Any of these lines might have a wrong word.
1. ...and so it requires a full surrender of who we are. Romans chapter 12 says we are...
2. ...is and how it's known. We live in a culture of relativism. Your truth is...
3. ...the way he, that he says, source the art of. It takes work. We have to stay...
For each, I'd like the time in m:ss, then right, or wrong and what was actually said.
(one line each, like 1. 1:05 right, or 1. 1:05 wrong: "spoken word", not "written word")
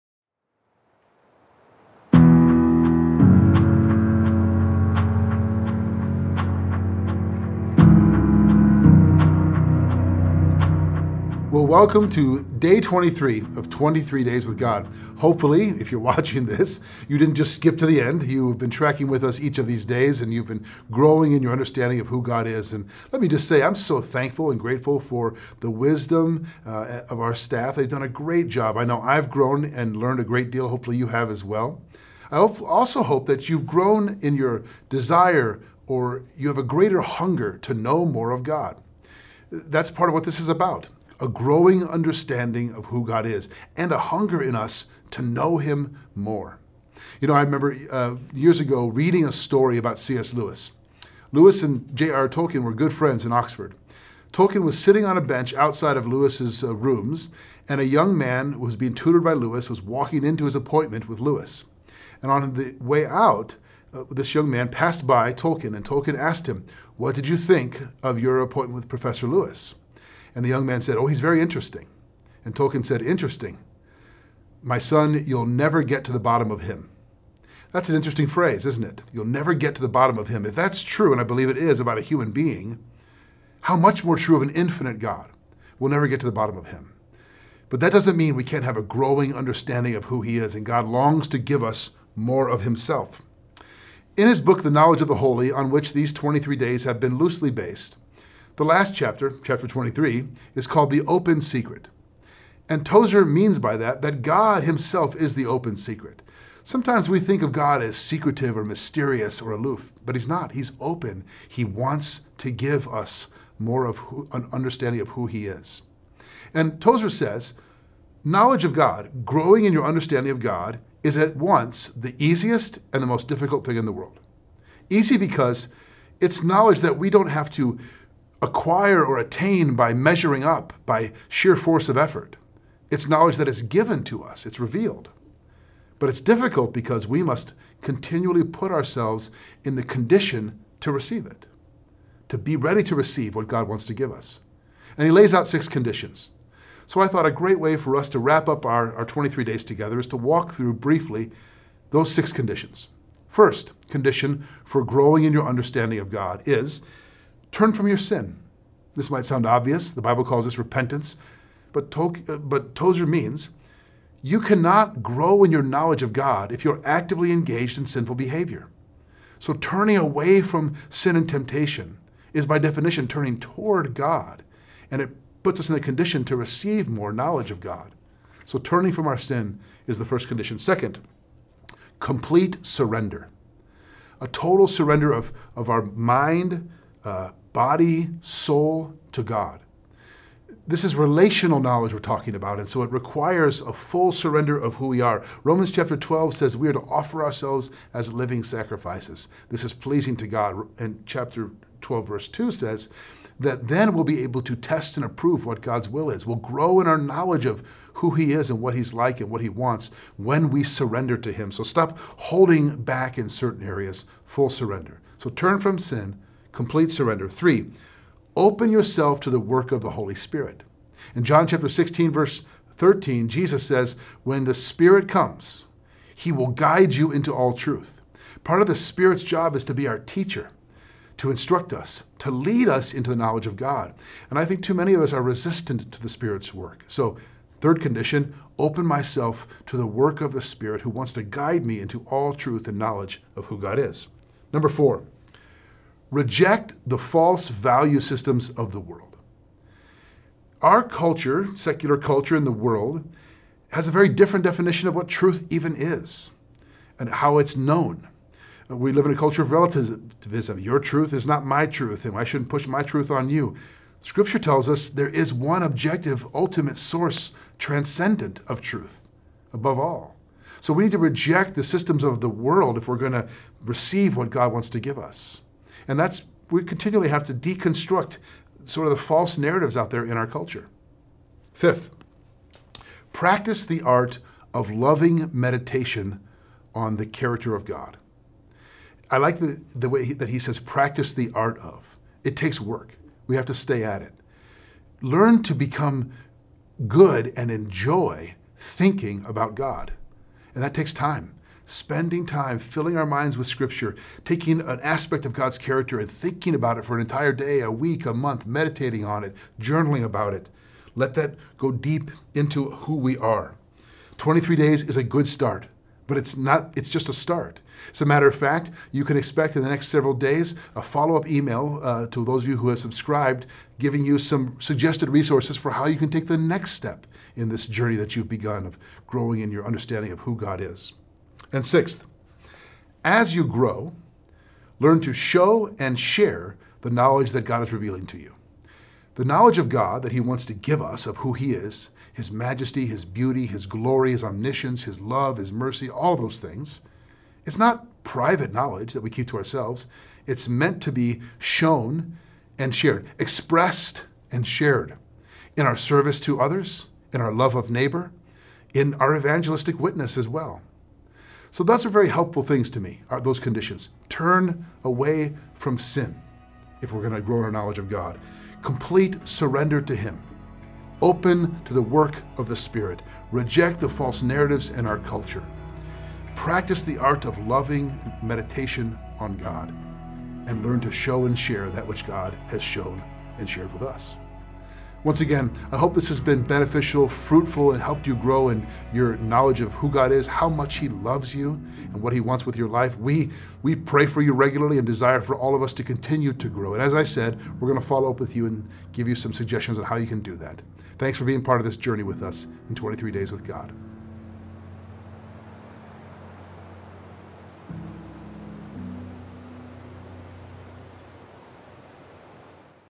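1. 3:12 right
2. 4:15 right
3. 4:49 wrong: "practice", not "source".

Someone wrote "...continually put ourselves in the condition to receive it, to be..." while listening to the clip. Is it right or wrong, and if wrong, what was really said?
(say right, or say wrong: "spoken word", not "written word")
right.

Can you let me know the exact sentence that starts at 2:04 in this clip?
Easy because it's knowledge that we don't have to acquire or attain by measuring up, by sheer force of effort.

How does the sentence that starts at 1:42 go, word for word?
And Tozer means by that that God himself is the open secret.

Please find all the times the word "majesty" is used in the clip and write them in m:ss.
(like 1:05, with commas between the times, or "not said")
5:42.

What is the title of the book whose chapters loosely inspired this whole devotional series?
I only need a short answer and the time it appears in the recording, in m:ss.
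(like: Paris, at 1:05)
The Knowledge of the Holy, at 1:34.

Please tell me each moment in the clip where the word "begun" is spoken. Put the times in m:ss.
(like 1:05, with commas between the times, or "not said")
5:28.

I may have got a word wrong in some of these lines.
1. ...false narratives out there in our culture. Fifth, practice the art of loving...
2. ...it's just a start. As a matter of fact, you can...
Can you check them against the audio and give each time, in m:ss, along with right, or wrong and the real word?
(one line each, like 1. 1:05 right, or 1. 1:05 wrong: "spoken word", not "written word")
1. 4:39 right
2. 5:16 right.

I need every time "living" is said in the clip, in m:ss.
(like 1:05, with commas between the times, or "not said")
3:18.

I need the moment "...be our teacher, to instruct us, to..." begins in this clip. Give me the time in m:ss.
3:49.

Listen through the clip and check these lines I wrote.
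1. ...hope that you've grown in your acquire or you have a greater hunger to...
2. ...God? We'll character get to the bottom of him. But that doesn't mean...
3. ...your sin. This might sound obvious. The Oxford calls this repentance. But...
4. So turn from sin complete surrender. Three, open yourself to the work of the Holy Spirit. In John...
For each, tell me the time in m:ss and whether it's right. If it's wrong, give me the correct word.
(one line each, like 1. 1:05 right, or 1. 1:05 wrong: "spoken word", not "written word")
1. 0:33 wrong: "desire", not "acquire"
2. 1:24 wrong: "never", not "character"
3. 2:37 wrong: "Bible", not "Oxford"
4. 3:35 right.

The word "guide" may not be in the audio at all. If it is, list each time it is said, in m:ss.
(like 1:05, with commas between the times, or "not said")
3:46, 4:01.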